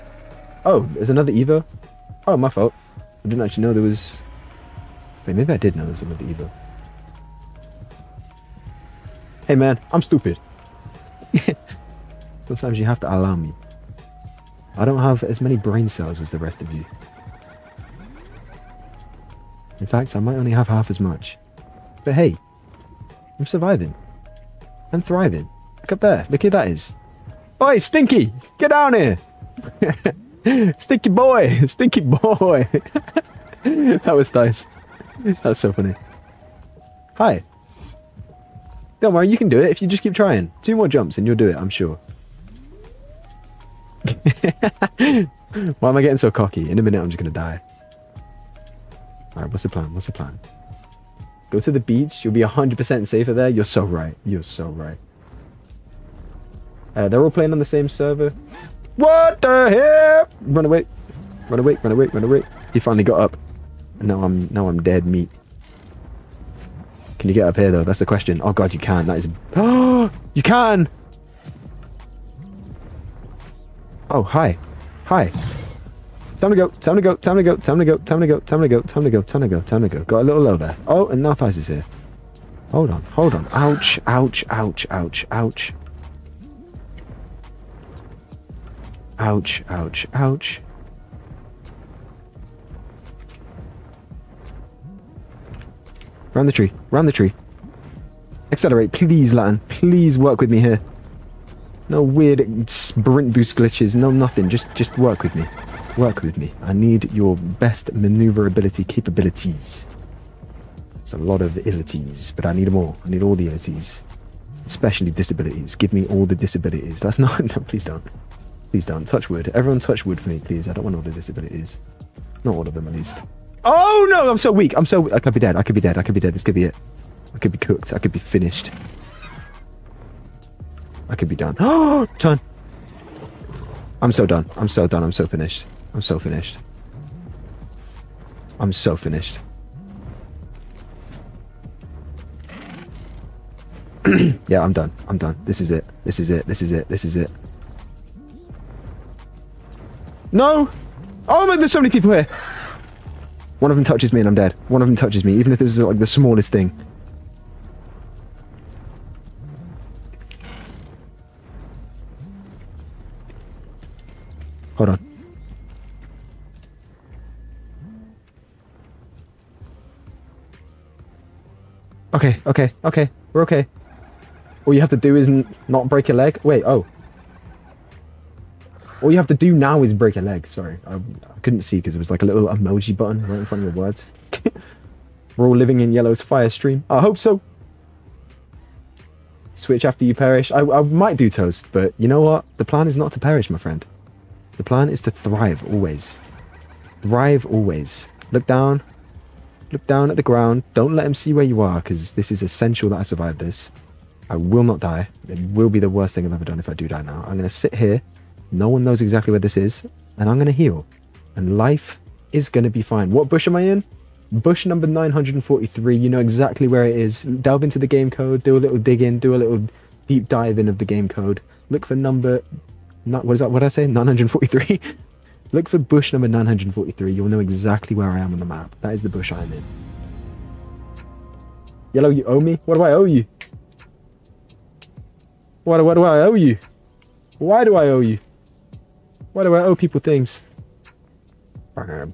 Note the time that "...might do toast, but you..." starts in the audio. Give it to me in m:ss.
3:10.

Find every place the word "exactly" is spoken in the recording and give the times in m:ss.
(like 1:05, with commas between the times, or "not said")
3:29, 3:36, 3:47.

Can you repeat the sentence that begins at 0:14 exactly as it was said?
I don't have as many brain cells as the rest of you.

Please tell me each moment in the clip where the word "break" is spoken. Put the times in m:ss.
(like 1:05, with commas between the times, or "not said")
2:55, 2:59.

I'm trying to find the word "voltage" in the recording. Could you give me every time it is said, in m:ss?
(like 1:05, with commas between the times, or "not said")
not said.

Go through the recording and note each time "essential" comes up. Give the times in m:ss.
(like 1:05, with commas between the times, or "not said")
3:22.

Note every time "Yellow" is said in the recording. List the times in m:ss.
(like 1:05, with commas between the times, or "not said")
3:05, 3:51.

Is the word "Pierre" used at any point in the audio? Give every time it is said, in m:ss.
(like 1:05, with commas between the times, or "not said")
not said.